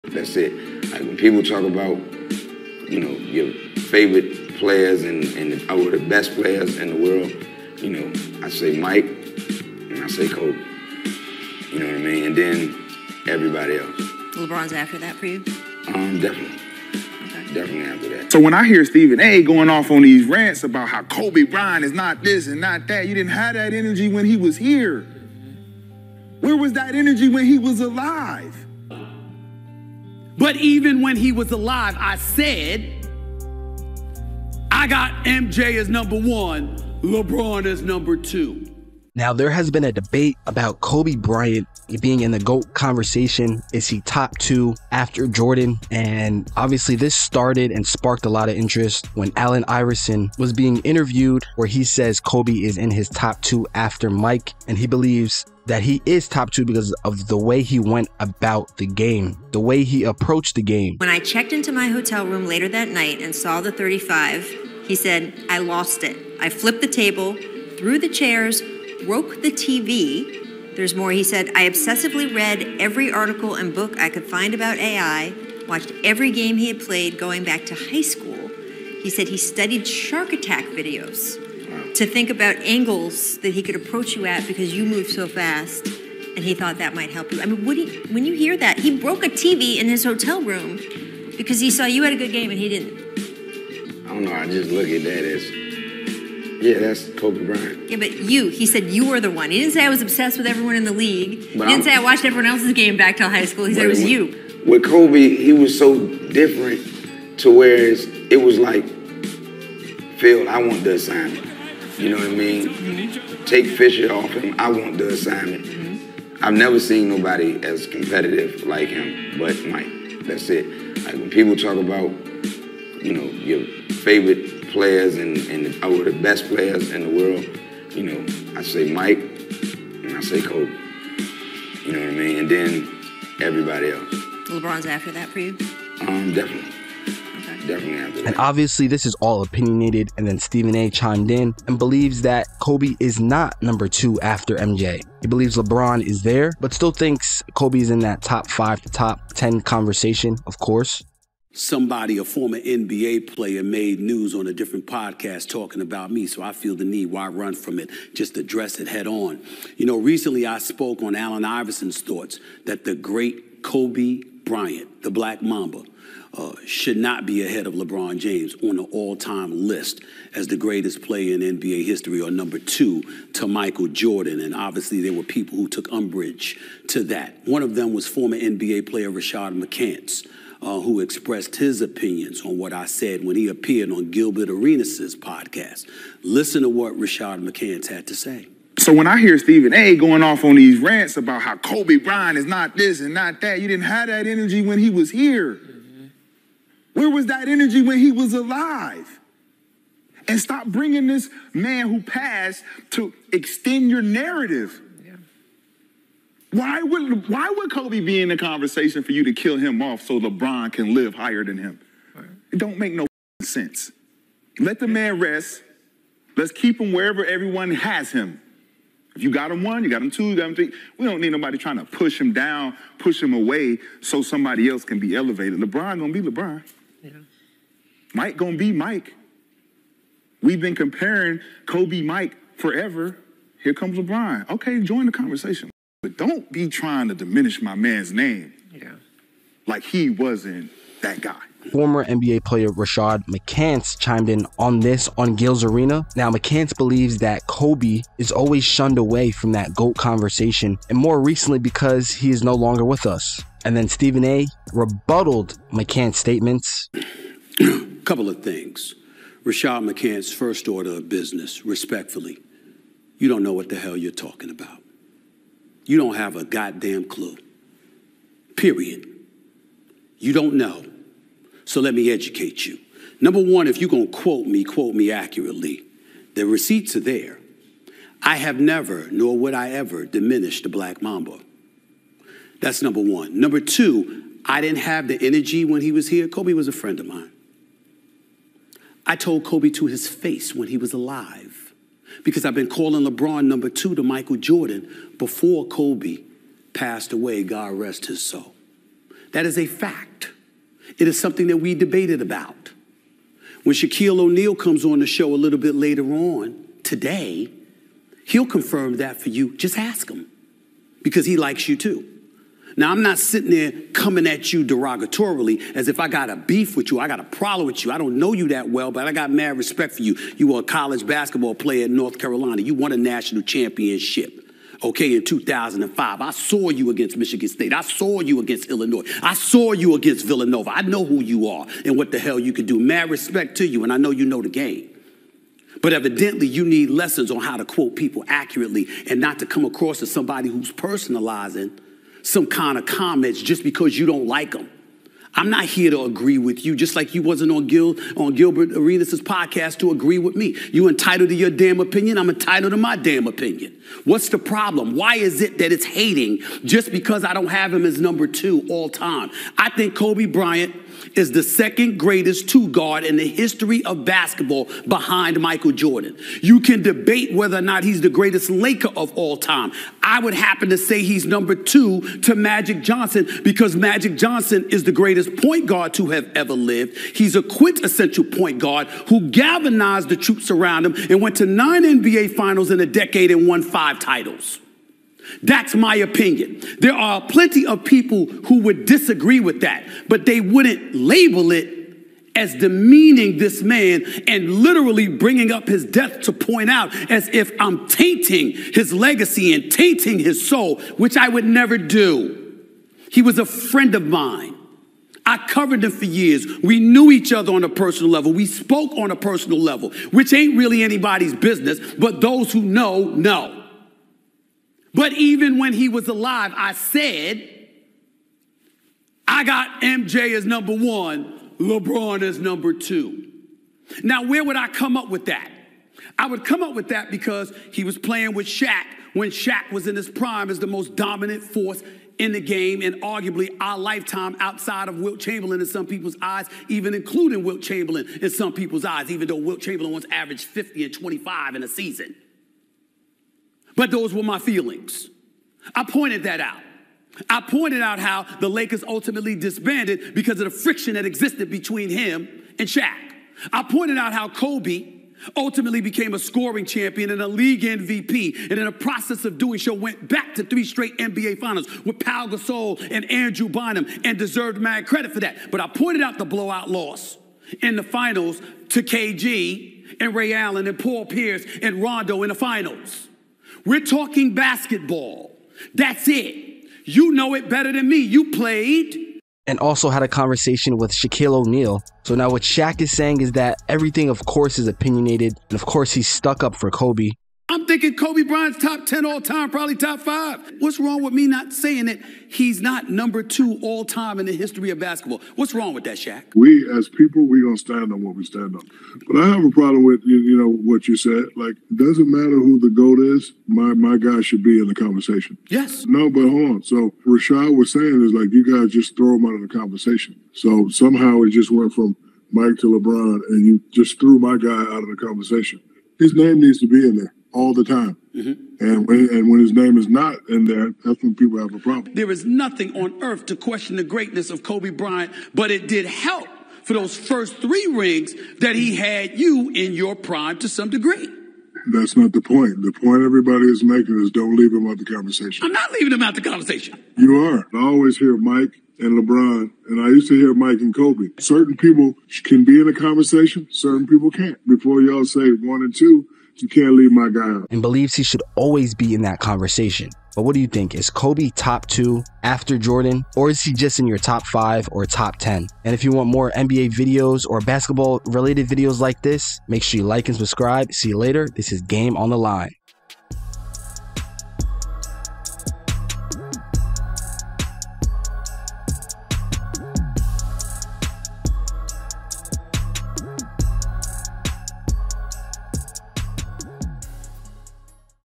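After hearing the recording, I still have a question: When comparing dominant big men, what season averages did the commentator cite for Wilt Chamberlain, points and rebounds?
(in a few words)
50 and 25.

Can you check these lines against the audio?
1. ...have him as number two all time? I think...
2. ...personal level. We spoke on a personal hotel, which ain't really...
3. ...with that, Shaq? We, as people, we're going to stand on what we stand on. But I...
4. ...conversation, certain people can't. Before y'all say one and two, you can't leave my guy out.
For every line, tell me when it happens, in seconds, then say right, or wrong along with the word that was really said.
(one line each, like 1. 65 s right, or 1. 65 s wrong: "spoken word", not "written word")
1. 357 s right
2. 407 s wrong: "level", not "hotel"
3. 495 s right
4. 542 s right.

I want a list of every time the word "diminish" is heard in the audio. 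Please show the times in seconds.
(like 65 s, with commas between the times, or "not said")
237 s, 280 s.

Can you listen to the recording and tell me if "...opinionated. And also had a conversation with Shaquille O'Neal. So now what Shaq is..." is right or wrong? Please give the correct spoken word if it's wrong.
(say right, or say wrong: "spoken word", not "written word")
wrong: "played", not "opinionated".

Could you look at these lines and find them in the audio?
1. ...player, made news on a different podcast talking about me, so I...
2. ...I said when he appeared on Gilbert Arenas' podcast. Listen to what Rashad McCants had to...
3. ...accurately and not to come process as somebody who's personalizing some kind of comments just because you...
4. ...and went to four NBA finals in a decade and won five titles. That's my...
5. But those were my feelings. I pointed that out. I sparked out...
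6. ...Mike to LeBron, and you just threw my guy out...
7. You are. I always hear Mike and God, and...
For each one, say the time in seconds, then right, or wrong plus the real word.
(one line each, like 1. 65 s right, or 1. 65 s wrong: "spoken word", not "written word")
1. 153 s right
2. 182 s right
3. 338 s wrong: "across", not "process"
4. 381 s wrong: "nine", not "four"
5. 443 s wrong: "pointed", not "sparked"
6. 512 s right
7. 536 s wrong: "LeBron", not "God".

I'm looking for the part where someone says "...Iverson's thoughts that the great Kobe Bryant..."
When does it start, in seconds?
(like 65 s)
161 s.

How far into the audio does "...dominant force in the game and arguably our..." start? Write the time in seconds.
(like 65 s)
430 s.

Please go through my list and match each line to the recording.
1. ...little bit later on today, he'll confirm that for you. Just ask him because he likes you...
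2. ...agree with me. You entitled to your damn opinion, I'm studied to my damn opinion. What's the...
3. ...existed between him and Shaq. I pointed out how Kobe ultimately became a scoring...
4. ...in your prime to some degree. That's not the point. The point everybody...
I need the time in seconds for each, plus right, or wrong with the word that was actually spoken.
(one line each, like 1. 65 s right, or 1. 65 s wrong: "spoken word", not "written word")
1. 305 s right
2. 349 s wrong: "entitled", not "studied"
3. 451 s right
4. 529 s right.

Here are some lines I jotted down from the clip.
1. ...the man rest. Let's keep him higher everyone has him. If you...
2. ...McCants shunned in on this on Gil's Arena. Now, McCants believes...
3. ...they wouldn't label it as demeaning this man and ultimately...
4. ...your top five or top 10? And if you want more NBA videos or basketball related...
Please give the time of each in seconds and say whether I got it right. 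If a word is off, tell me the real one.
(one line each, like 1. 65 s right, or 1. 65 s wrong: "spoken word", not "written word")
1. 214 s wrong: "wherever", not "higher"
2. 243 s wrong: "chimed", not "shunned"
3. 390 s wrong: "literally", not "ultimately"
4. 553 s right.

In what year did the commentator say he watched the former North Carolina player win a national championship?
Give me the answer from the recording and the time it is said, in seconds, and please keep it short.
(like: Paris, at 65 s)
2005, at 325 s.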